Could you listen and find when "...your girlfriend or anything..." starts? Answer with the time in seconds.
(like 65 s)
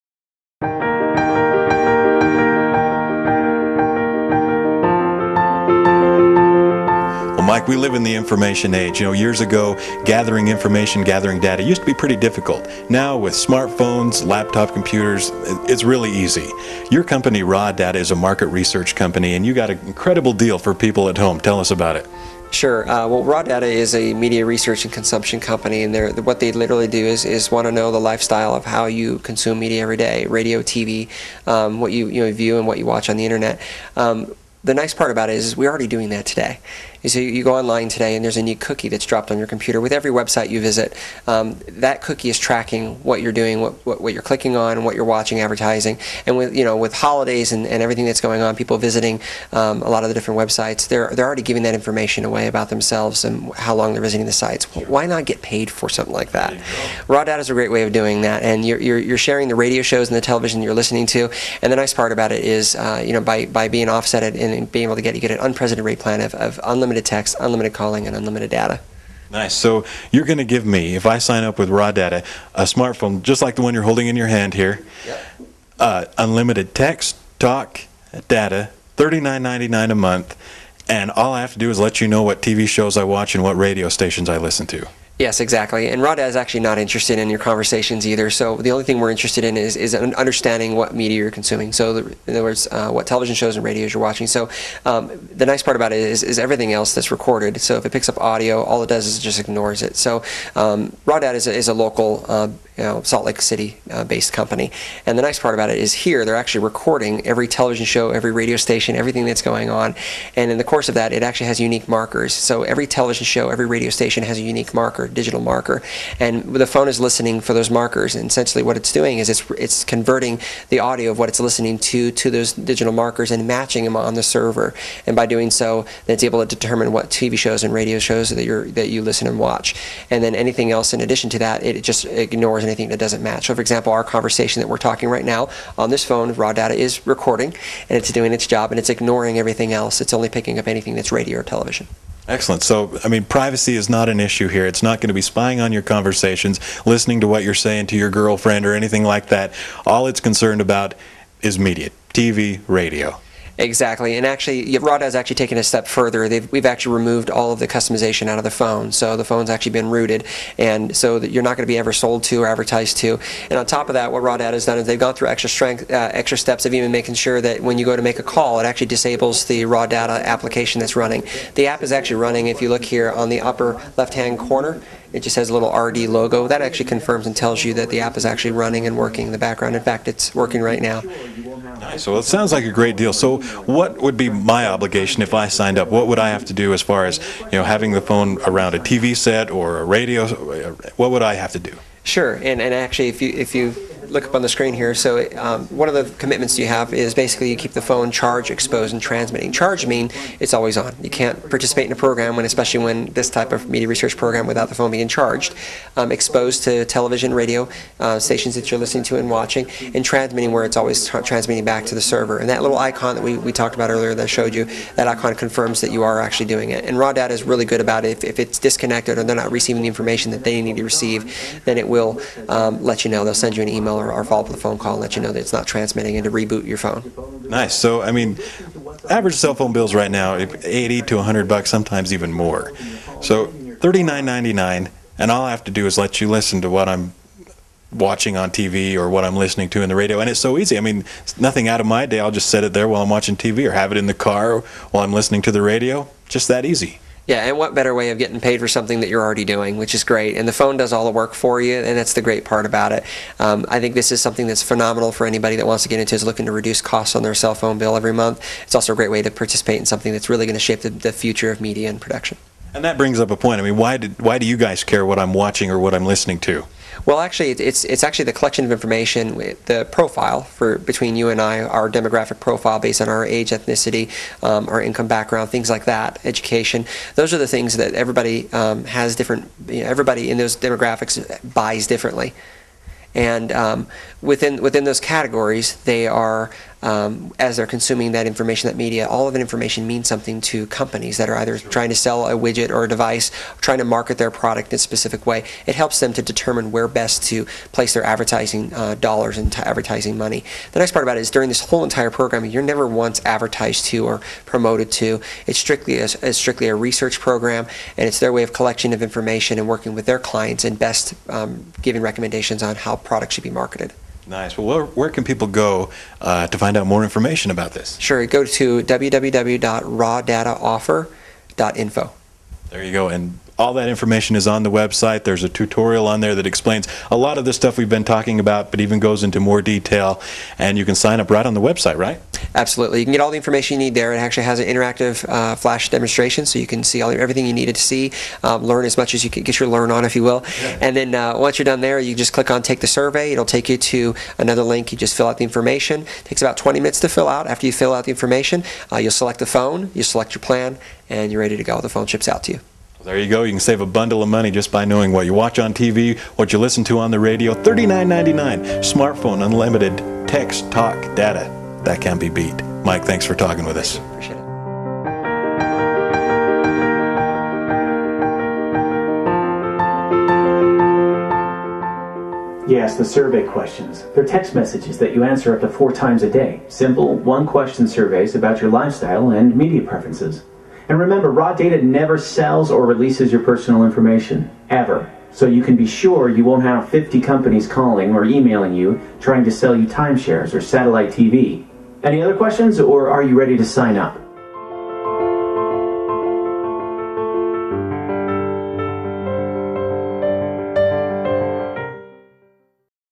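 147 s.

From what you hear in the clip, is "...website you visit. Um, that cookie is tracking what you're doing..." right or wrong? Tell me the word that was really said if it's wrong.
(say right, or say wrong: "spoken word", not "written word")
right.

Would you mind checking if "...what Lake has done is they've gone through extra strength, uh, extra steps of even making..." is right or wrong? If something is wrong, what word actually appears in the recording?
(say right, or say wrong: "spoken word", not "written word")
wrong: "Rada", not "Lake".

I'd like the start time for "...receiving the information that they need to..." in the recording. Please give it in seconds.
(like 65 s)
219 s.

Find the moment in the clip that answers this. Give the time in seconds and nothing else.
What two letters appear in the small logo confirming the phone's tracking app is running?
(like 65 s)
175 s.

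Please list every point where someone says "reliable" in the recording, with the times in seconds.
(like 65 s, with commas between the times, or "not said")
not said.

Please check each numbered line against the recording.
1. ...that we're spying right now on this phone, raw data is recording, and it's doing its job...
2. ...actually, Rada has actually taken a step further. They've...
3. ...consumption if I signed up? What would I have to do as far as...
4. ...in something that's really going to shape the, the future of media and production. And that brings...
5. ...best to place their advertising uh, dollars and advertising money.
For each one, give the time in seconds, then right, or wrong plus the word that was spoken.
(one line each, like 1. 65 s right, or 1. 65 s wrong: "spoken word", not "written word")
1. 134 s wrong: "talking", not "spying"
2. 154 s right
3. 184 s wrong: "obligation", not "consumption"
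4. 259 s right
5. 296 s right.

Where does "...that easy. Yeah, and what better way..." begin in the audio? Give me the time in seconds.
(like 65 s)
246 s.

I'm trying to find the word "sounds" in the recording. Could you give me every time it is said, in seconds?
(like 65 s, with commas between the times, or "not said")
182 s.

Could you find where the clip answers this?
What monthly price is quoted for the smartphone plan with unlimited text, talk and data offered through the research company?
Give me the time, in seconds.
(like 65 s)
78 s.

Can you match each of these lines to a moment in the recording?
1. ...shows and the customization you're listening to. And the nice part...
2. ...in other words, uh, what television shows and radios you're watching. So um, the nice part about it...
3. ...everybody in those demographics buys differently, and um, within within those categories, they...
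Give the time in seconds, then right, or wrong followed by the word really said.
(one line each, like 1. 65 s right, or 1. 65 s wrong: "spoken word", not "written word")
1. 59 s wrong: "television", not "customization"
2. 92 s right
3. 279 s right.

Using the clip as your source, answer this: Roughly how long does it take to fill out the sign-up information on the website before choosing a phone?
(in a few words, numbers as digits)
20 minutes.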